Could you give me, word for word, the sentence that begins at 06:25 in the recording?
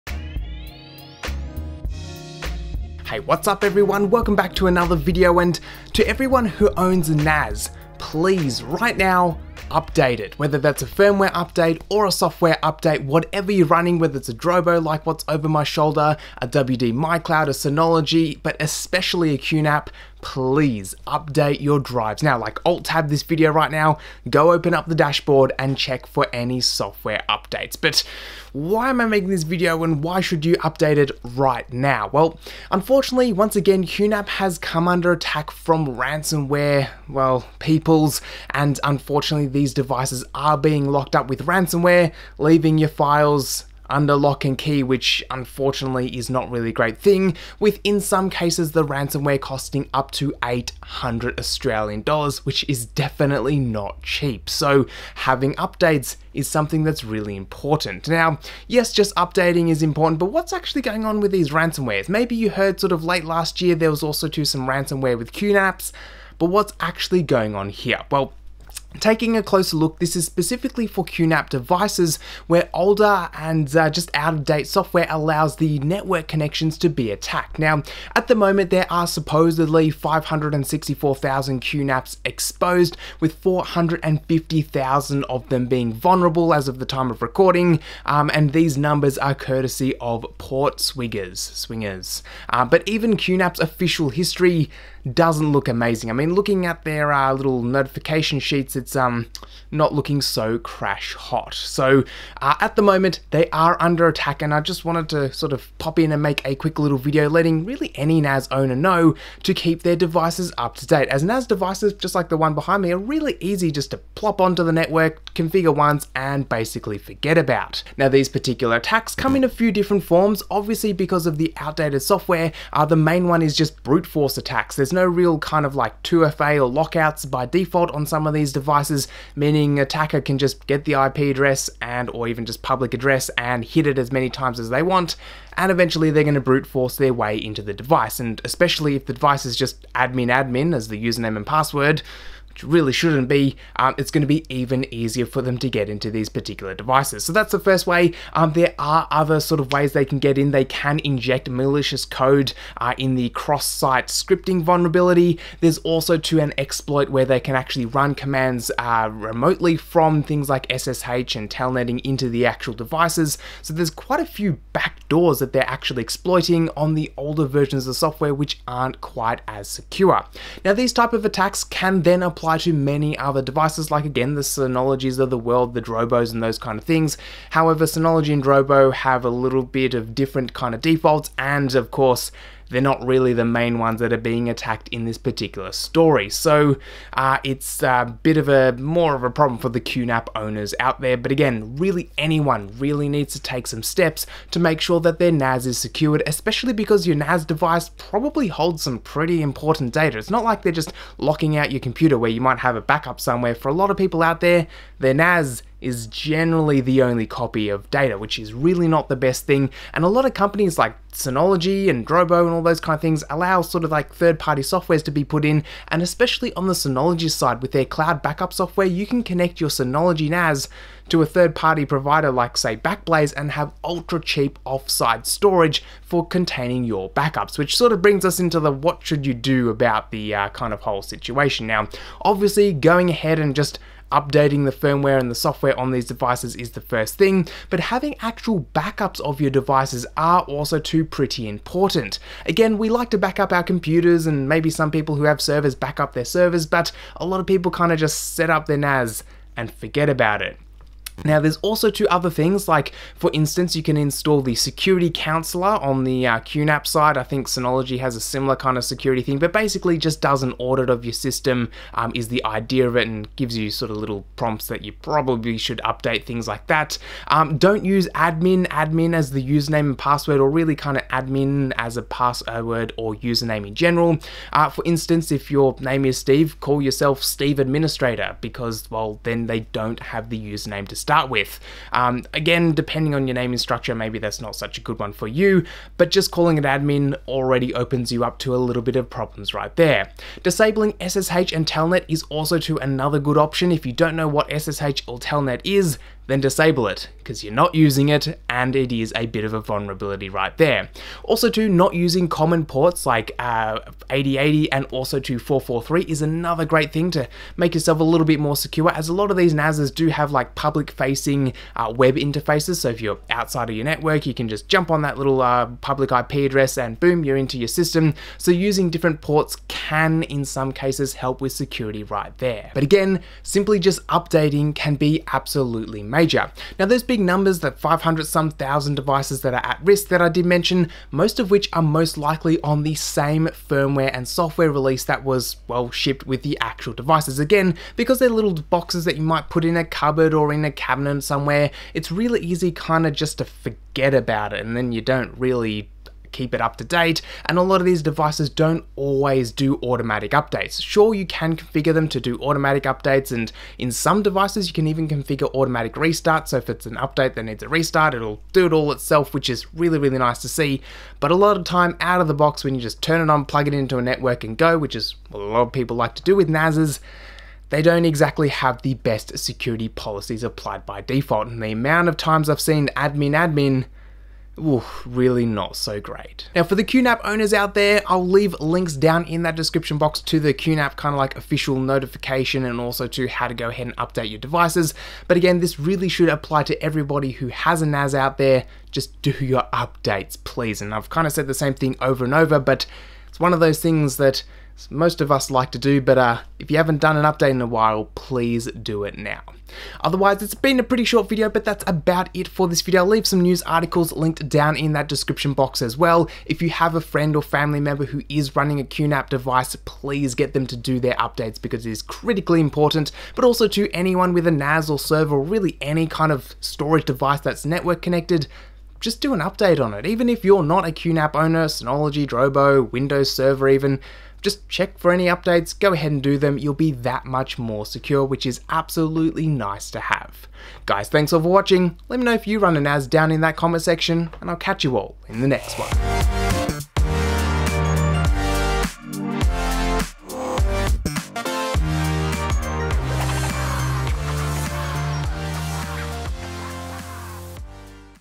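But again, this really should apply to everybody who has a NAS out there.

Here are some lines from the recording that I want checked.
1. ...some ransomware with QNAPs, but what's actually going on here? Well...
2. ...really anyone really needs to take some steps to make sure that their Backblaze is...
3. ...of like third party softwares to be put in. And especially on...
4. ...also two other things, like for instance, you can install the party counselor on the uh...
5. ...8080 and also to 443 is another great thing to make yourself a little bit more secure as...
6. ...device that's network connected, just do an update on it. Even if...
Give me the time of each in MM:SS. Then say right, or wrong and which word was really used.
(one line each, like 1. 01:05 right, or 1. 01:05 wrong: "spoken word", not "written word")
1. 01:04 right
2. 03:11 wrong: "NAS", not "Backblaze"
3. 03:33 right
4. 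04:11 wrong: "security", not "party"
5. 05:04 right
6. 06:57 right.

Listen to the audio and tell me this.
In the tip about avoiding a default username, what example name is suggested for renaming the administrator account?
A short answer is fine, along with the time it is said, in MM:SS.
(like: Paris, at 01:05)
Steve Administrator, at 04:37.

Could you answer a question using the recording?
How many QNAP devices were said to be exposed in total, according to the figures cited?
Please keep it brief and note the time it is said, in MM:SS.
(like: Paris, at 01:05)
564,000, at 01:19.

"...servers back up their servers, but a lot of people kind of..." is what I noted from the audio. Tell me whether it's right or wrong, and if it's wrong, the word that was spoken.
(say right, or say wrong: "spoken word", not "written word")
right.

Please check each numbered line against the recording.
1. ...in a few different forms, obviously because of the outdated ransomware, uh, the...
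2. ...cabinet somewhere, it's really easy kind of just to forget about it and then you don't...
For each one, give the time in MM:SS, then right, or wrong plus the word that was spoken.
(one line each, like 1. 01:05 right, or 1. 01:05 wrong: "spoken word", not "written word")
1. 01:59 wrong: "software", not "ransomware"
2. 05:40 right.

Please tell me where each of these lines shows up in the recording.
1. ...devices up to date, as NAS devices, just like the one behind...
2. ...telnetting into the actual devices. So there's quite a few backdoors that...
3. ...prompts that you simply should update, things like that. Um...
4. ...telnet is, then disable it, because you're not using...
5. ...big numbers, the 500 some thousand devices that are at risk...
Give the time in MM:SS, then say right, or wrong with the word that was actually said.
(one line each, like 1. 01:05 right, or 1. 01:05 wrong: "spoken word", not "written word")
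1. 01:49 right
2. 02:41 right
3. 04:24 wrong: "probably", not "simply"
4. 04:55 right
5. 05:27 right.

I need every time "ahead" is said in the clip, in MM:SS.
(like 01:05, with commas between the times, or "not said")
03:53, 06:23, 07:05.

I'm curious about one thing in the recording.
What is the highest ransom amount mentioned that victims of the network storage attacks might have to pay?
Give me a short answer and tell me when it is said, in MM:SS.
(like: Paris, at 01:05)
800 Australian dollars, at 00:50.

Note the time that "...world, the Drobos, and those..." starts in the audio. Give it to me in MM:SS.
02:55.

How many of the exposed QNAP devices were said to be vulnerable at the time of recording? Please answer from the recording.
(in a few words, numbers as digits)
450,000.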